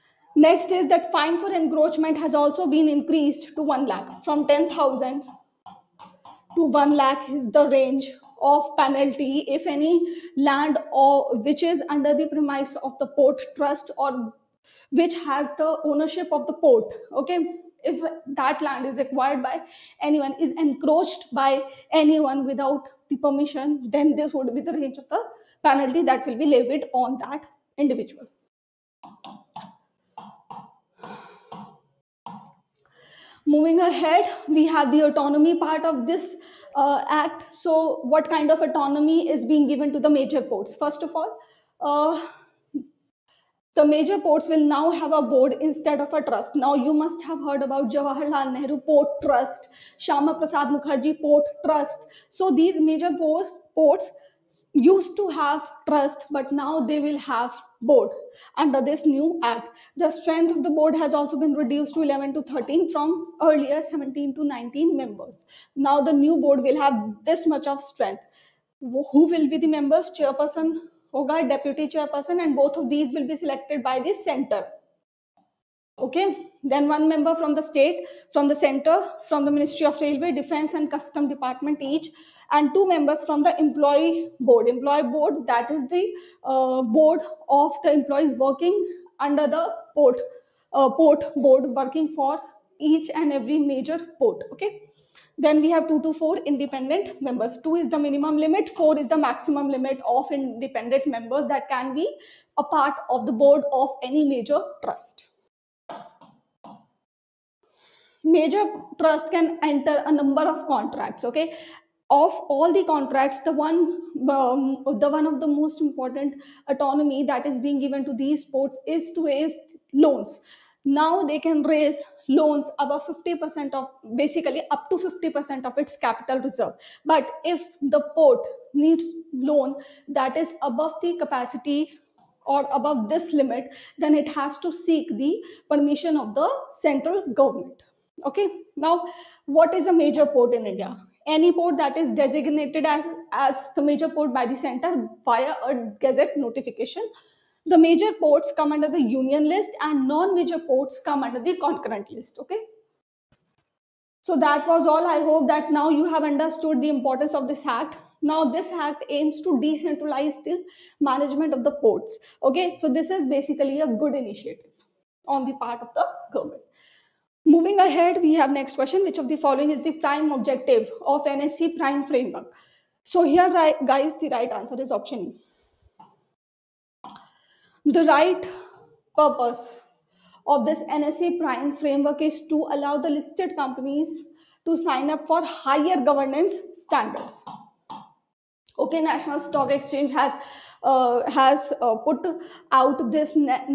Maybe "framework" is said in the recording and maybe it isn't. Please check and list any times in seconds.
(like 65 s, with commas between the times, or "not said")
172 s, 181 s.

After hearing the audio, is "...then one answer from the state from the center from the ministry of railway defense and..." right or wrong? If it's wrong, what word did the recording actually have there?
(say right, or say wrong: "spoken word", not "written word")
wrong: "member", not "answer".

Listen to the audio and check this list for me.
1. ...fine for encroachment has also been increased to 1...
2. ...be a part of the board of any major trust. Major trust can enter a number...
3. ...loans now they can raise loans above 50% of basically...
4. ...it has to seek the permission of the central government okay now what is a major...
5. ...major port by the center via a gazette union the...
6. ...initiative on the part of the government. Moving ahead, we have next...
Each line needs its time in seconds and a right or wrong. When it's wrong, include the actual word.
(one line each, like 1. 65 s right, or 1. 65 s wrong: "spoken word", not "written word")
1. 1 s right
2. 101 s right
3. 119 s right
4. 134 s right
5. 143 s wrong: "notification", not "union"
6. 164 s right.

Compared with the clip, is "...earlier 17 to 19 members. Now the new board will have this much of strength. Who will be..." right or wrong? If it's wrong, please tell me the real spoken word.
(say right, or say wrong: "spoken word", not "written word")
right.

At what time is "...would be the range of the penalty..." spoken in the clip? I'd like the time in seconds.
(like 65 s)
24 s.